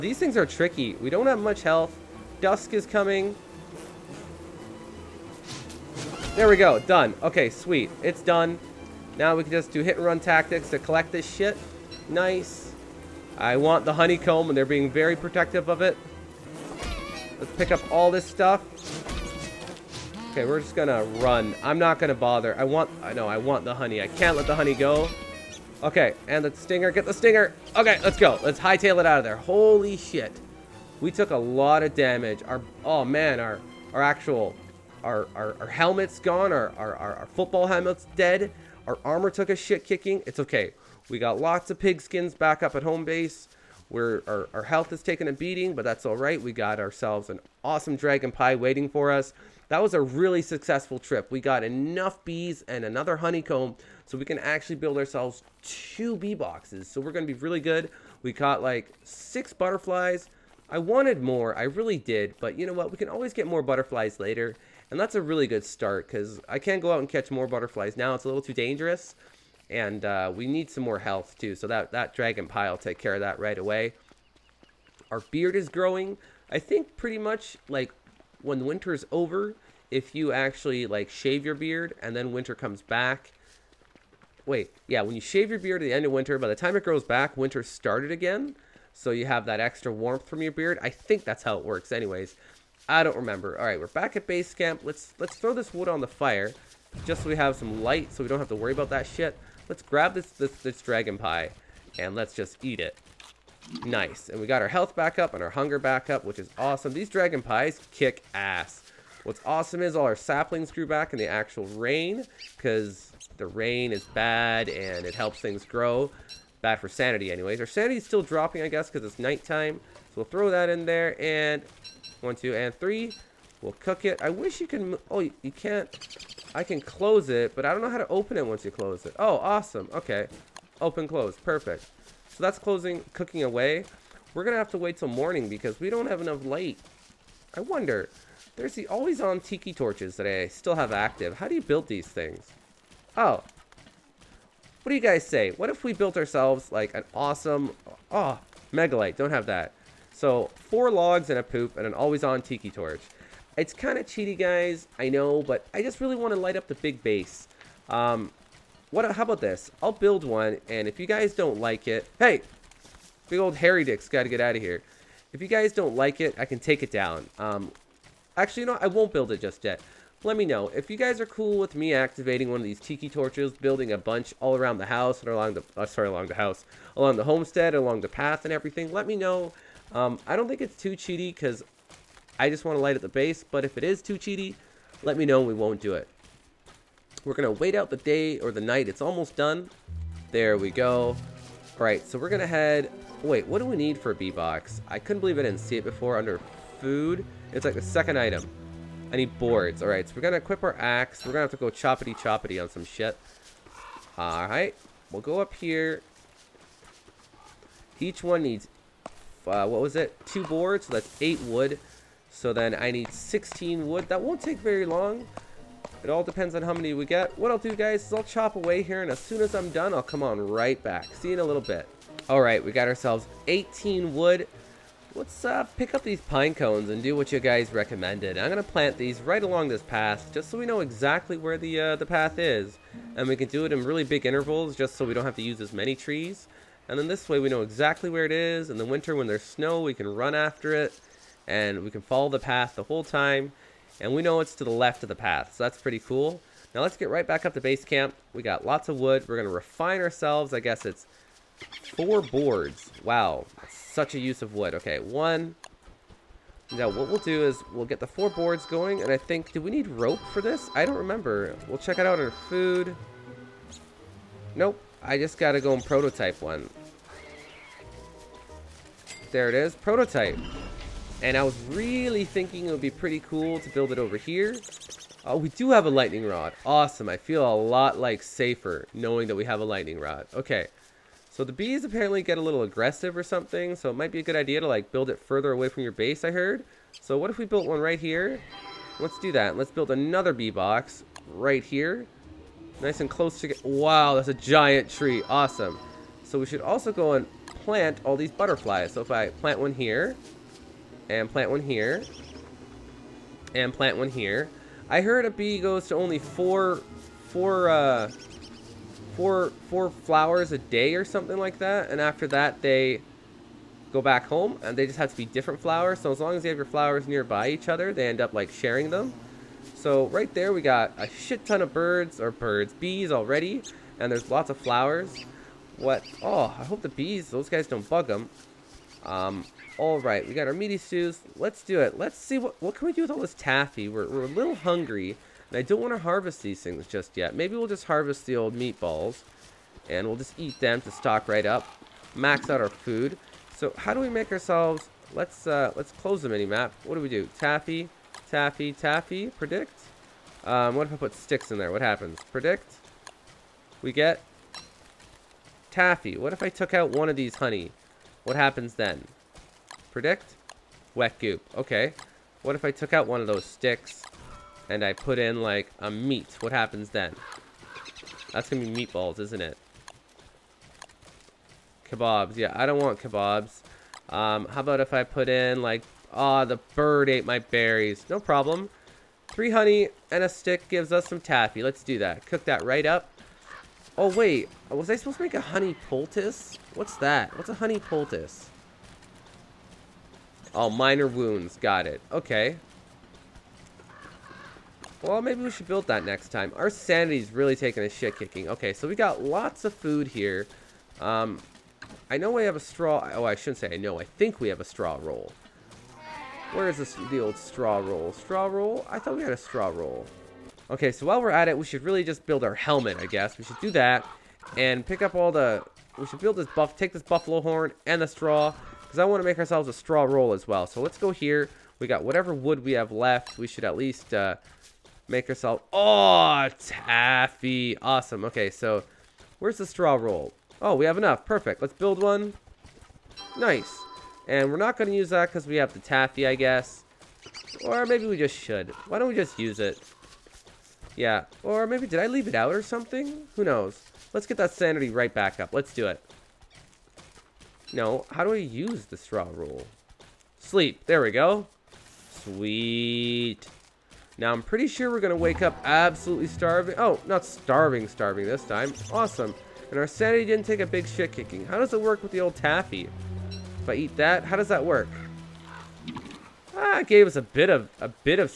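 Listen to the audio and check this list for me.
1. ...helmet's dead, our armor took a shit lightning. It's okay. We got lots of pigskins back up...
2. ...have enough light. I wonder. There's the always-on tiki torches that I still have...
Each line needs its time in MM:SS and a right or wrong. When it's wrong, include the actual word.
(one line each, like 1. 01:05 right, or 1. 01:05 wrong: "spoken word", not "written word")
1. 00:37 wrong: "kicking", not "lightning"
2. 02:16 right.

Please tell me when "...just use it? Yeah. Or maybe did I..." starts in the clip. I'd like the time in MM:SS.
07:19.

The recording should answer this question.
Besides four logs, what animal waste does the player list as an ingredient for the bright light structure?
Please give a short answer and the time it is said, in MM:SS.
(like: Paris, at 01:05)
a poop, at 02:31.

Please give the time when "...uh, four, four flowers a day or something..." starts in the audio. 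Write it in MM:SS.
05:07.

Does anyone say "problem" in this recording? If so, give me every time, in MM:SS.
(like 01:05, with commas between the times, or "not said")
06:18.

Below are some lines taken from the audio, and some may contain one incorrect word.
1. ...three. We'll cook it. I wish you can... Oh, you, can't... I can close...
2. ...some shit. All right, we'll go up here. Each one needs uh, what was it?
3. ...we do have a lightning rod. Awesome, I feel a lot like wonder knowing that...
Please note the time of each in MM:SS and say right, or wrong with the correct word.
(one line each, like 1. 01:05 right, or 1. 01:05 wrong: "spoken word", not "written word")
1. 02:02 right
2. 03:22 right
3. 04:35 wrong: "safer", not "wonder".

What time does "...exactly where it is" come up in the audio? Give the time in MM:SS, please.
03:57.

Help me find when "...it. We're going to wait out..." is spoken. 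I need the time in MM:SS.
03:05.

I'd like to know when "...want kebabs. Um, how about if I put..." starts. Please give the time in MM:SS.
06:12.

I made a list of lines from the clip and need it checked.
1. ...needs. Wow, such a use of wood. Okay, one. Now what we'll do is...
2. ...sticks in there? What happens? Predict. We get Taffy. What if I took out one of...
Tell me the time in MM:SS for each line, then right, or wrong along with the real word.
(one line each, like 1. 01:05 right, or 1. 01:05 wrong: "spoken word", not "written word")
1. 04:12 wrong: "boards", not "needs"
2. 05:51 right.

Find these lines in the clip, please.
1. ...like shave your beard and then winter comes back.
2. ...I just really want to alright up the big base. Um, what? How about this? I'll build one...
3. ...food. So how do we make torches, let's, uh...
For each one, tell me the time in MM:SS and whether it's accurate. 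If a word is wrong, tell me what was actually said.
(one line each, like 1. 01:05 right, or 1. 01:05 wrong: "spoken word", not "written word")
1. 01:20 right
2. 02:35 wrong: "light", not "alright"
3. 05:42 wrong: "ourselves", not "torches".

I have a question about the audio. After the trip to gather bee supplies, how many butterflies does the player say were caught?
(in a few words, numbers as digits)
6.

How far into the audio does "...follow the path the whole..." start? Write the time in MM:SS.
04:02.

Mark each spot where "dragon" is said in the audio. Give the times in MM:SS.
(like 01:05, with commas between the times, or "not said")
00:47, 01:12, 01:40, 01:47.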